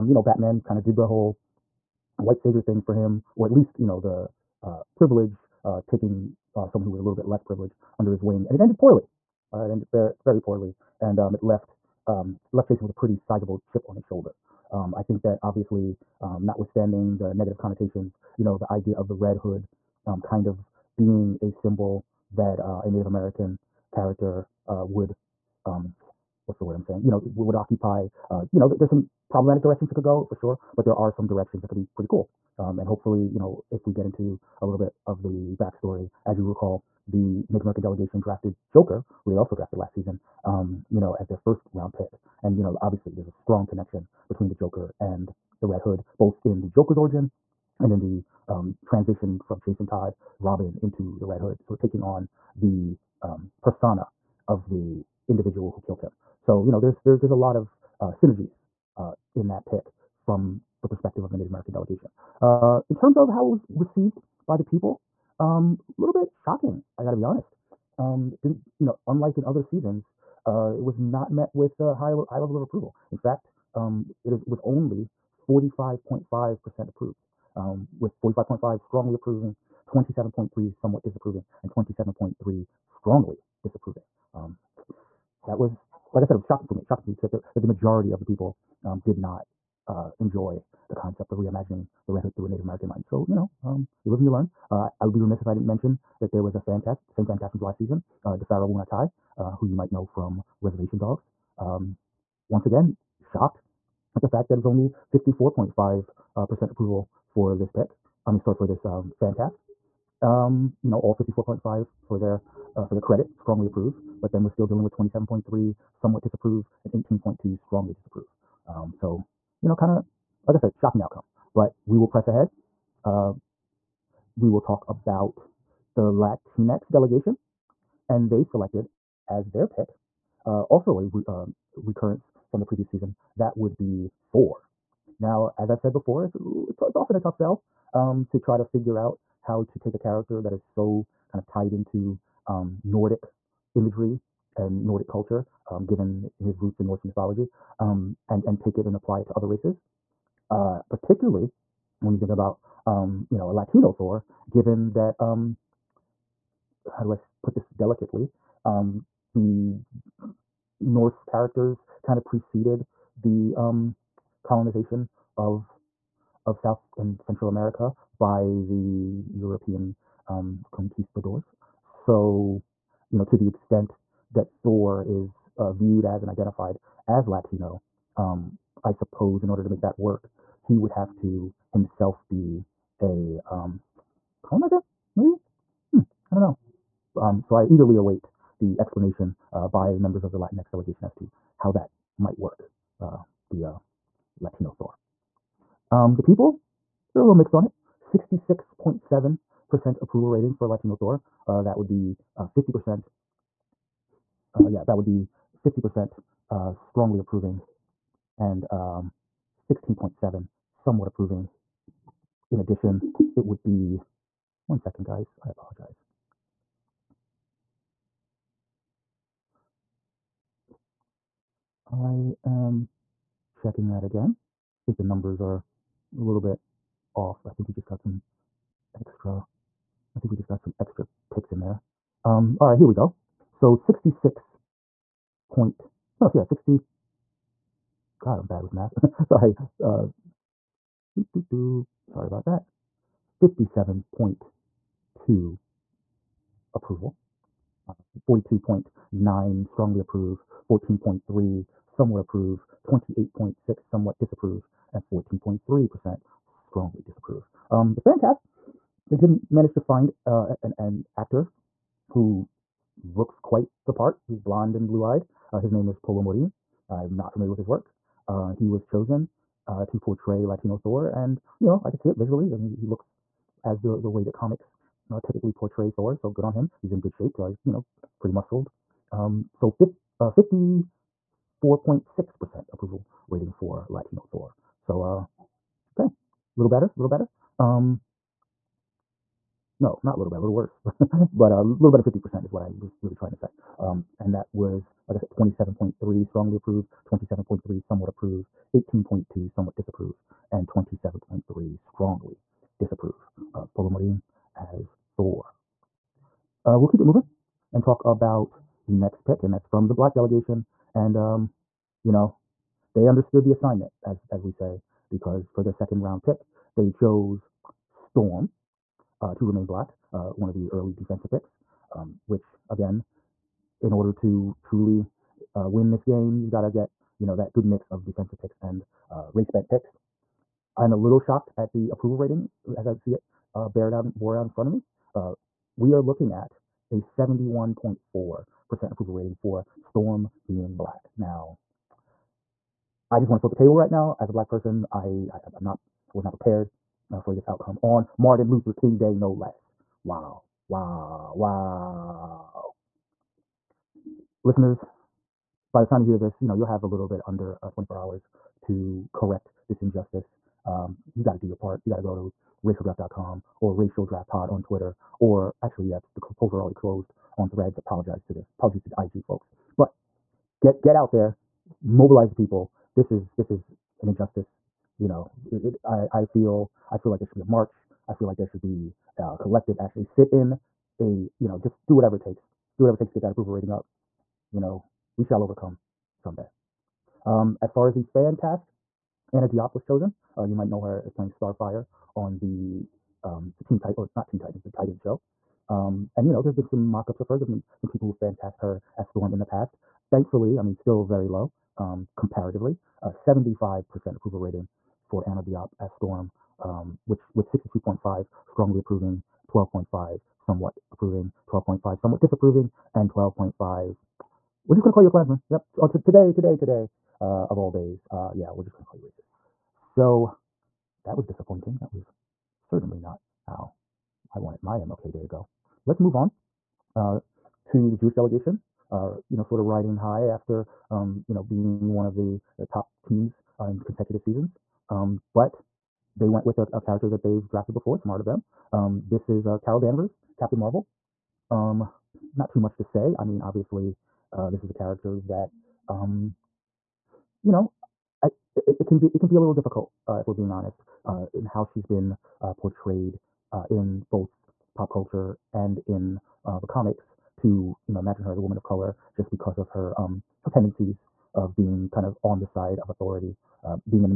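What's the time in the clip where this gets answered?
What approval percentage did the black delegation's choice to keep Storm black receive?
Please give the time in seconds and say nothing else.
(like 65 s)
337 s.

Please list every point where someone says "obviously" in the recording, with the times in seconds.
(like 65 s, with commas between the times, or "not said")
15 s, 42 s, 443 s.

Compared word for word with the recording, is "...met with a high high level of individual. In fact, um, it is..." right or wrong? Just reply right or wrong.
wrong.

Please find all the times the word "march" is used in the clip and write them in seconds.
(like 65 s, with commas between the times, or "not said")
377 s.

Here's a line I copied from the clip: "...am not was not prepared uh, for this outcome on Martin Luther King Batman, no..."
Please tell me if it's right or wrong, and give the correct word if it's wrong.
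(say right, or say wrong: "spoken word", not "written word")
wrong: "Day", not "Batman".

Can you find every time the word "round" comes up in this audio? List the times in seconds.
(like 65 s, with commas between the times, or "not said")
41 s, 316 s.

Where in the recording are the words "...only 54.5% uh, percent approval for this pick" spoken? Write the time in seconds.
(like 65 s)
104 s.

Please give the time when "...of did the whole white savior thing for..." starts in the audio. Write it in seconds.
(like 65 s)
0 s.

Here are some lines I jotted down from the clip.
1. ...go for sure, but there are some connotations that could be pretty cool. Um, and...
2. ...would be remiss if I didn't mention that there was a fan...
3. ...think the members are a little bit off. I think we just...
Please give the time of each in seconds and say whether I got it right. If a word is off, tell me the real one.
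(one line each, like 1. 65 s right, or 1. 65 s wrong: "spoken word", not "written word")
1. 30 s wrong: "directions", not "connotations"
2. 95 s right
3. 224 s wrong: "numbers", not "members".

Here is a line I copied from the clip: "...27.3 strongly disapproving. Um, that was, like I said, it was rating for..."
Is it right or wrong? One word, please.
wrong.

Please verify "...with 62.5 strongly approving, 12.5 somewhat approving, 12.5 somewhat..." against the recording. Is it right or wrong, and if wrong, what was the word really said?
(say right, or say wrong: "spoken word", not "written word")
right.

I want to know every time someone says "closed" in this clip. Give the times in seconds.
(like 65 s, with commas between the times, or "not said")
366 s.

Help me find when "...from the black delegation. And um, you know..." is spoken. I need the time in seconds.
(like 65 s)
309 s.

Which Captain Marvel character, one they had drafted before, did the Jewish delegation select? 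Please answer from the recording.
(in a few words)
Carol Danvers.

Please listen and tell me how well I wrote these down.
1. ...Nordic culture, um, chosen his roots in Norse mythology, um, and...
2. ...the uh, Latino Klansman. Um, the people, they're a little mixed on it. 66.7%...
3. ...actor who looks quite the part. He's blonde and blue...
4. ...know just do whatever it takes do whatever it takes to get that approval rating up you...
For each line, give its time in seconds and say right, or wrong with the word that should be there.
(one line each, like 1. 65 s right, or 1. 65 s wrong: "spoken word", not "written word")
1. 144 s wrong: "given", not "chosen"
2. 193 s wrong: "Thor", not "Klansman"
3. 261 s right
4. 381 s right.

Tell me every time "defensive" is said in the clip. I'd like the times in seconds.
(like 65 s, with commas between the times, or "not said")
320 s, 328 s.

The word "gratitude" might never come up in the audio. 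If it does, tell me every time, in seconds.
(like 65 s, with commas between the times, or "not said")
not said.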